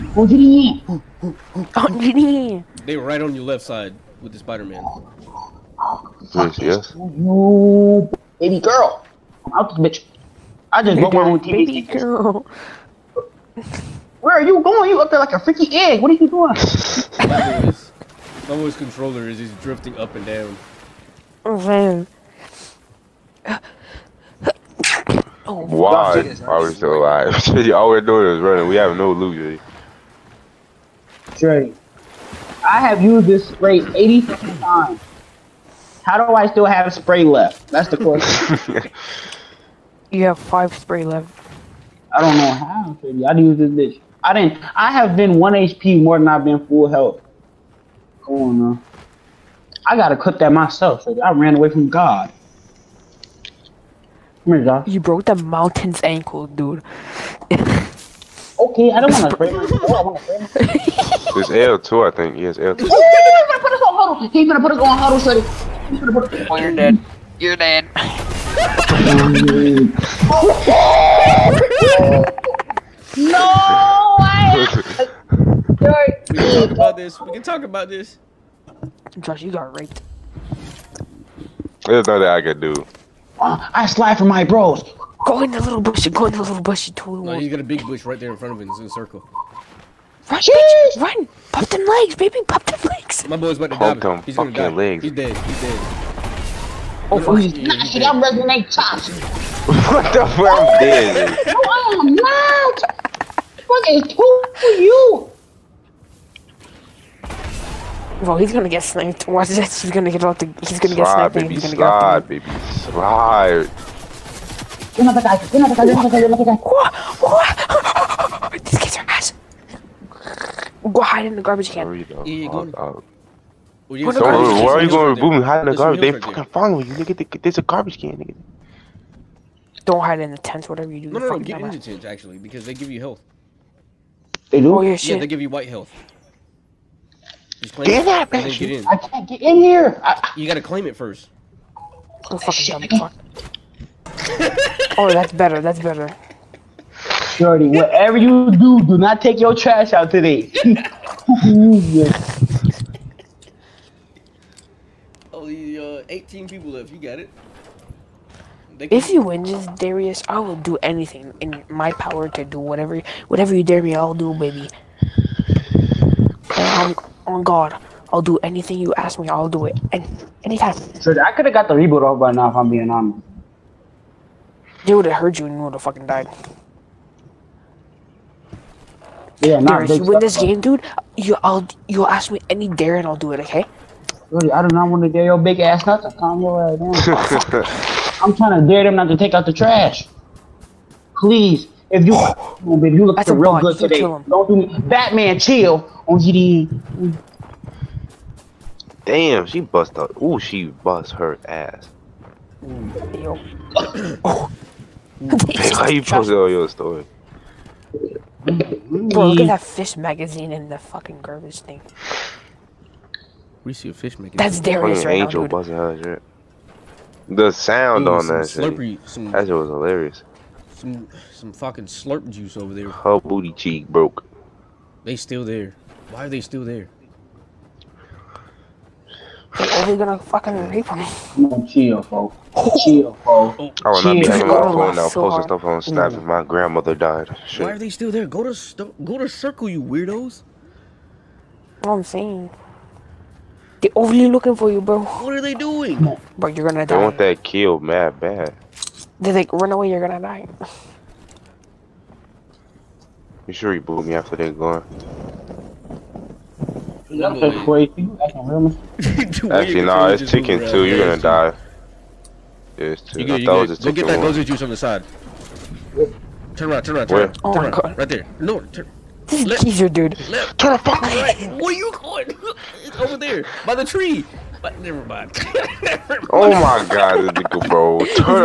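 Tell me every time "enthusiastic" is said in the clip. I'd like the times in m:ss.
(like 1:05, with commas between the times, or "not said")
not said.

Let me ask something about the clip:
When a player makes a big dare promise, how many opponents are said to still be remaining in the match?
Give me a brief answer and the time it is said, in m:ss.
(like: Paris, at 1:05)
18, at 2:36.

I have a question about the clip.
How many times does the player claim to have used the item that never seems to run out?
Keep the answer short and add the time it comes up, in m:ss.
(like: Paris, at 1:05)
80, at 0:33.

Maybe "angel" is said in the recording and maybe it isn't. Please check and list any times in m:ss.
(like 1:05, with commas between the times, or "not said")
3:35.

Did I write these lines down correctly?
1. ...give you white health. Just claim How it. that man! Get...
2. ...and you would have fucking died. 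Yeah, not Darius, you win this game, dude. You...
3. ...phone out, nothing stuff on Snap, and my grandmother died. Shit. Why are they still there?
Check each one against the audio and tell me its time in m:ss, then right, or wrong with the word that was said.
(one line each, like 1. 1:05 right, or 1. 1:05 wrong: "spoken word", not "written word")
1. 2:15 wrong: "Get", not "How"
2. 2:55 right
3. 3:54 wrong: "posting", not "nothing".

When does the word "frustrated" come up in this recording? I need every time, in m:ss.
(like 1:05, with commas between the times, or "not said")
not said.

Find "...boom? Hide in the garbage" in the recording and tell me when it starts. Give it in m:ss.
2:05.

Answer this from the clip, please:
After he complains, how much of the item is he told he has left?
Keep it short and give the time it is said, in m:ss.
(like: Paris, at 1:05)
5, at 0:40.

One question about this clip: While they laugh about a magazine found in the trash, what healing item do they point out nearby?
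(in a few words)
slurp juice.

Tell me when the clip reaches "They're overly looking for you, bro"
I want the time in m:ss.
4:03.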